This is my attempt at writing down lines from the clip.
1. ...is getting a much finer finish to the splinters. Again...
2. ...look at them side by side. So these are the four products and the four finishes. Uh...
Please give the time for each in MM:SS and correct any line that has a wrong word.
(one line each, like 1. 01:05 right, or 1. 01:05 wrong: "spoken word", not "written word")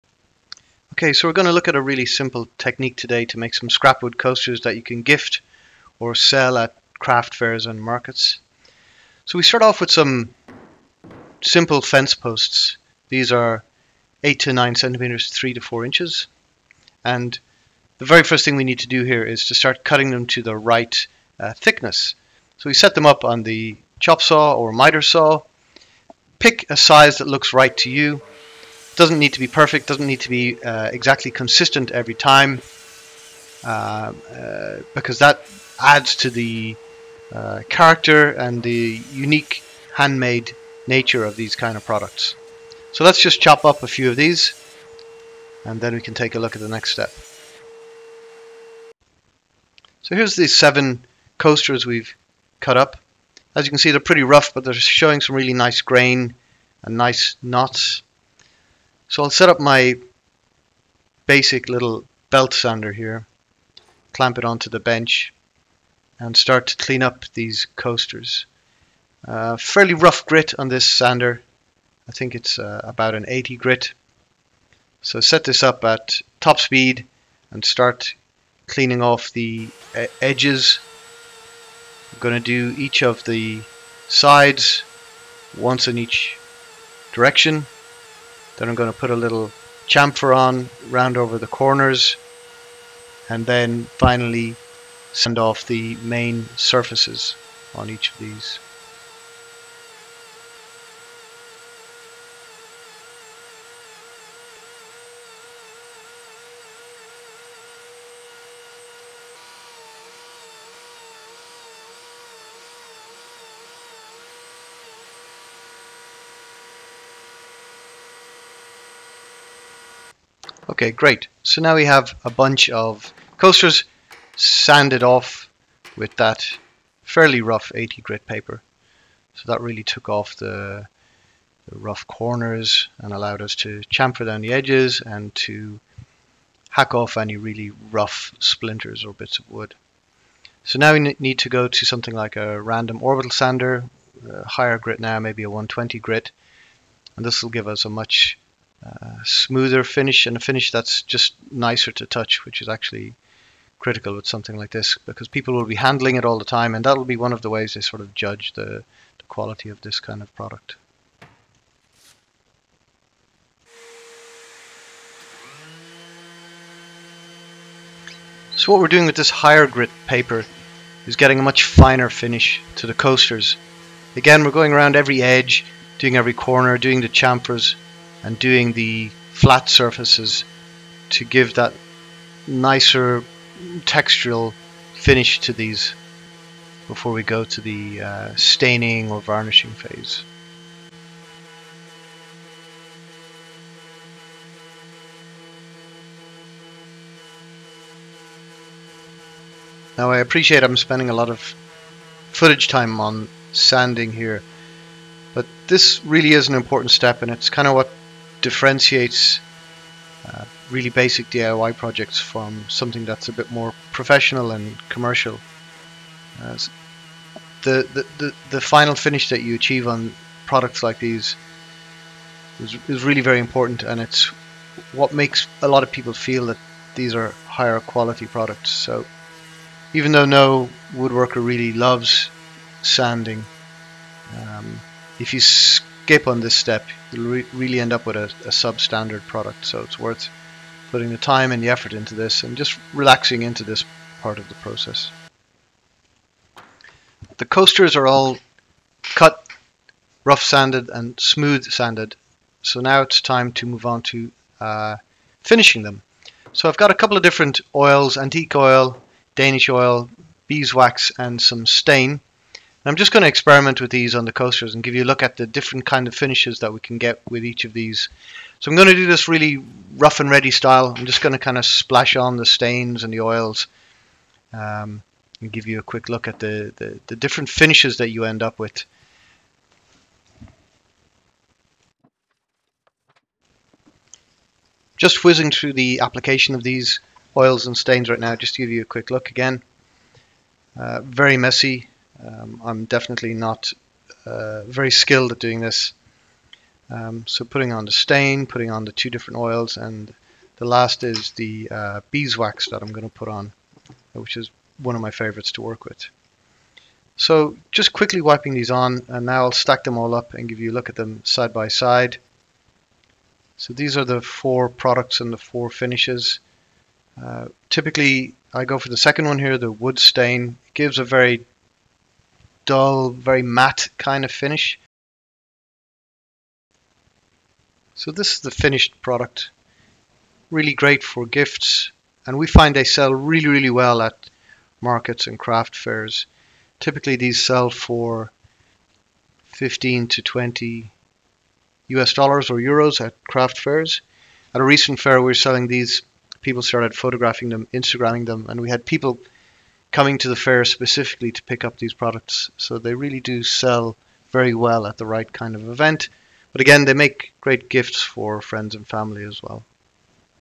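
1. 02:51 wrong: "coasters", not "splinters"
2. 05:10 right.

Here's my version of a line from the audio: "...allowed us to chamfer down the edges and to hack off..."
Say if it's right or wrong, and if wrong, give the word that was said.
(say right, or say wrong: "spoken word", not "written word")
right.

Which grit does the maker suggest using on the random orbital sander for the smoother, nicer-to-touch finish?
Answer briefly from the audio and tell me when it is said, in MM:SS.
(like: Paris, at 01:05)
120 grit, at 02:25.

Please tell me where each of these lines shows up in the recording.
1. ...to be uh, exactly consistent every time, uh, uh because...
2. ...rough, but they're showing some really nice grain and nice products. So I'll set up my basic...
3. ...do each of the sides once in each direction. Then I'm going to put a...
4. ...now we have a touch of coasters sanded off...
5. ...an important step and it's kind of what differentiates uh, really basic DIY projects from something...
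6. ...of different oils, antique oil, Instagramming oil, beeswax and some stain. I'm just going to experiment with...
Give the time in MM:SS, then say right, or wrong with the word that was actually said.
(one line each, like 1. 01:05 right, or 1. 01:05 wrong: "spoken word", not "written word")
1. 00:30 right
2. 00:54 wrong: "knots", not "products"
3. 01:22 right
4. 02:01 wrong: "bunch", not "touch"
5. 03:26 right
6. 04:17 wrong: "Danish", not "Instagramming".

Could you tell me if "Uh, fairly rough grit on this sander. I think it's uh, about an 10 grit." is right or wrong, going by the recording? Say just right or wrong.
wrong.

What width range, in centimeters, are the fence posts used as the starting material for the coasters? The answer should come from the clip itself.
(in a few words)
8 to 9 centimeters.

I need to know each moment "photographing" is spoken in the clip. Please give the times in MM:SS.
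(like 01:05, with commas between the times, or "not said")
05:46.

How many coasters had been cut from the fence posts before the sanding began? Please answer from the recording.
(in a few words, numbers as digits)
7.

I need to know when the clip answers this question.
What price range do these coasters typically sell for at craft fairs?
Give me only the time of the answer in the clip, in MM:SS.
05:39.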